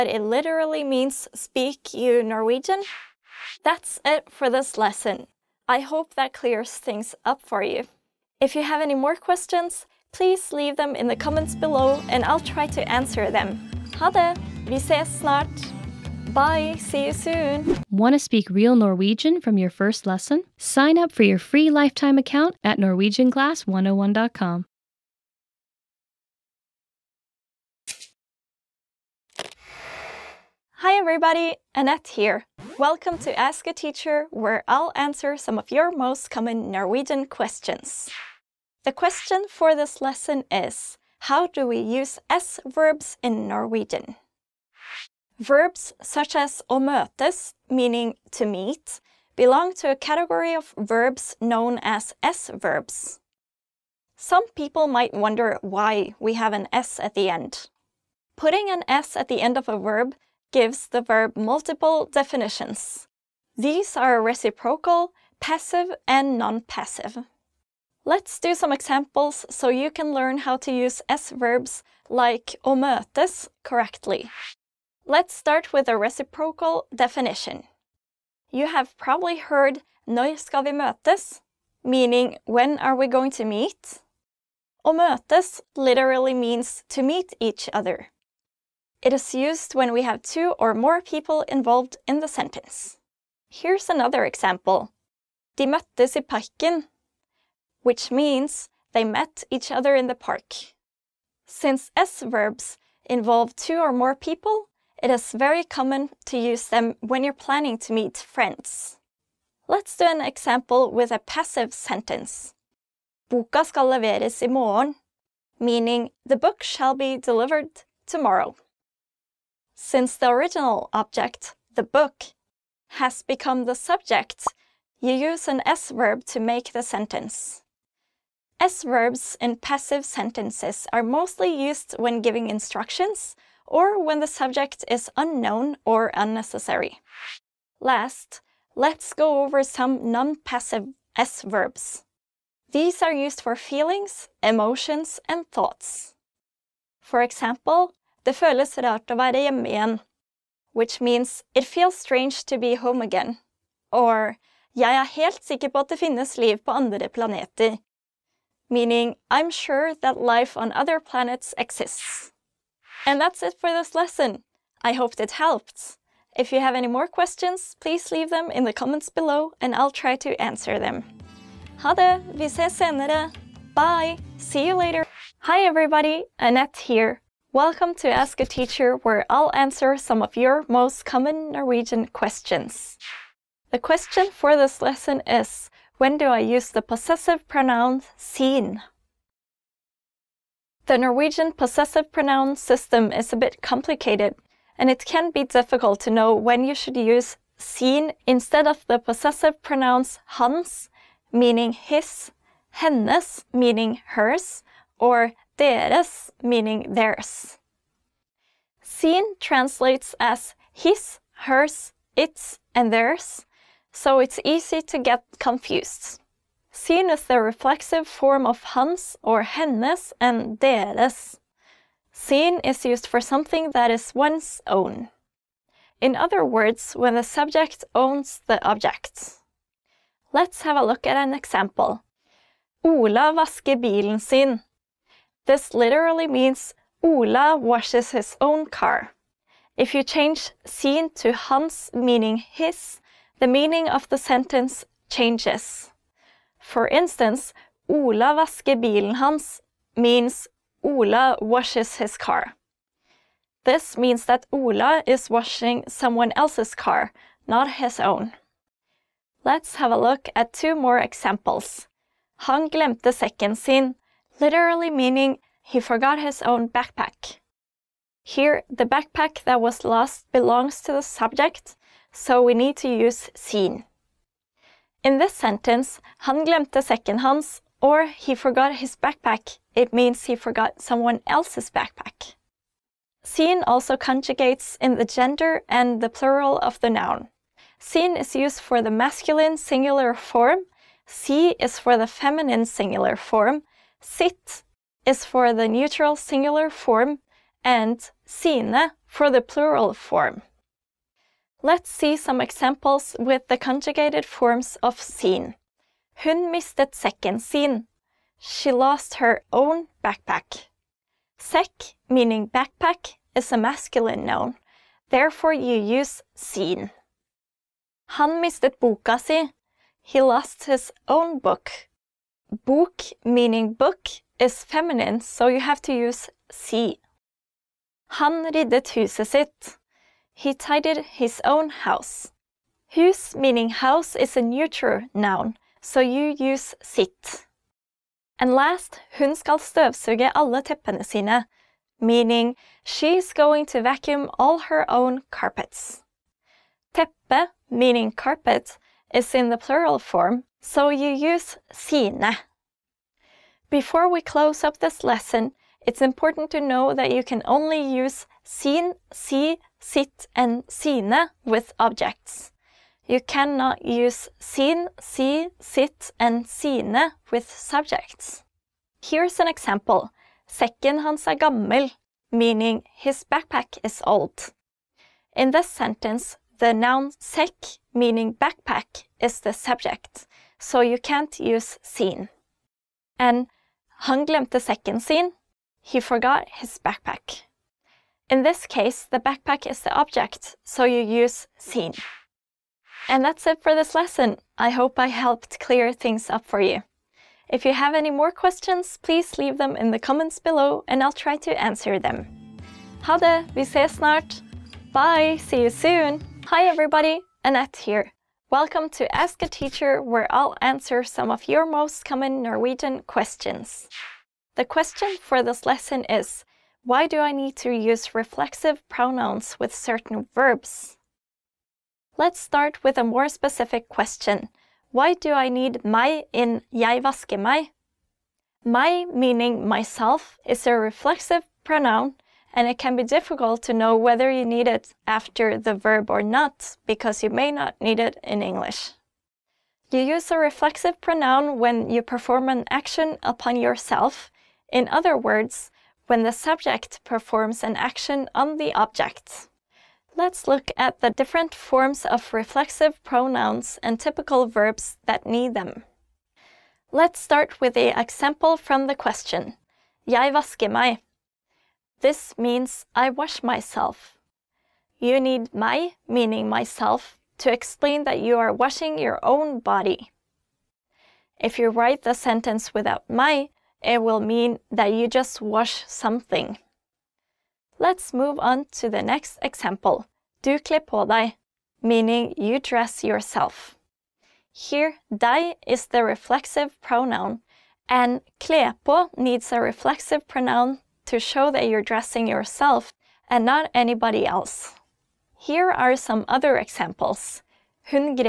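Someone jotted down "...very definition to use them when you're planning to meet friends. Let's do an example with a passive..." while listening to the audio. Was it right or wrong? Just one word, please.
wrong.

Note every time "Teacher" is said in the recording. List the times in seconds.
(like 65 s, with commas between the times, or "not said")
33 s, 178 s, 409 s.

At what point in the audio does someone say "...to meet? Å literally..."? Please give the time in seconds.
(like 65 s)
83 s.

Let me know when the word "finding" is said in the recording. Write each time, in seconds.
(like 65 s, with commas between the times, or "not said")
not said.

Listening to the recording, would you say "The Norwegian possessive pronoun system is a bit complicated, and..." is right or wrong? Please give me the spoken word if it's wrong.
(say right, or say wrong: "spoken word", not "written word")
right.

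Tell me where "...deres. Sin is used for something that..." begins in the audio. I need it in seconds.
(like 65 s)
220 s.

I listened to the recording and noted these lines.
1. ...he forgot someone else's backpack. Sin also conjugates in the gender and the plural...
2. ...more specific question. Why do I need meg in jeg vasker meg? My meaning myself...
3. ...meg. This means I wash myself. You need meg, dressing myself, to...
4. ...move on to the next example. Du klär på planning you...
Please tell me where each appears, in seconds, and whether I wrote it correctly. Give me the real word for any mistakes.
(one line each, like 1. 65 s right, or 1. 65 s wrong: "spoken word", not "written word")
1. 280 s right
2. 423 s right
3. 460 s wrong: "meaning", not "dressing"
4. 478 s wrong: "meaning", not "planning".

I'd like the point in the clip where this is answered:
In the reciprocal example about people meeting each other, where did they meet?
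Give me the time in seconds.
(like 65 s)
96 s.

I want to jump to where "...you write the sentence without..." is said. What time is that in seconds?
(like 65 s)
471 s.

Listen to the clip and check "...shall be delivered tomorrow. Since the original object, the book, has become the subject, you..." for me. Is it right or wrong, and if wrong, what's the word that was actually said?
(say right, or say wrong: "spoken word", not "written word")
right.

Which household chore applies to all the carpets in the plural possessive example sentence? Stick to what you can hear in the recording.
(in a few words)
vacuum.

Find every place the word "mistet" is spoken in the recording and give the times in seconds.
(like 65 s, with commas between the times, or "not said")
306 s, 318 s.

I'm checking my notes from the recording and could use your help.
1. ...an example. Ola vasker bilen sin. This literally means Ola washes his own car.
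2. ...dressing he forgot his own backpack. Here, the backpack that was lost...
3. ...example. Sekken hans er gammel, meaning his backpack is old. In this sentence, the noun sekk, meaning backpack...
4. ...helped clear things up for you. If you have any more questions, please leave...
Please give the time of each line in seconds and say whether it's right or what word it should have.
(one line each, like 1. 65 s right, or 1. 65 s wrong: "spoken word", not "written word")
1. 231 s right
2. 264 s wrong: "meaning", not "dressing"
3. 369 s right
4. 395 s right.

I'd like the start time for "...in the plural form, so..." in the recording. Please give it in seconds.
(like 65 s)
349 s.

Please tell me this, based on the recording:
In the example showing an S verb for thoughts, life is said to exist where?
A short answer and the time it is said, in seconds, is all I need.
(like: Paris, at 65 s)
on other planets, at 156 s.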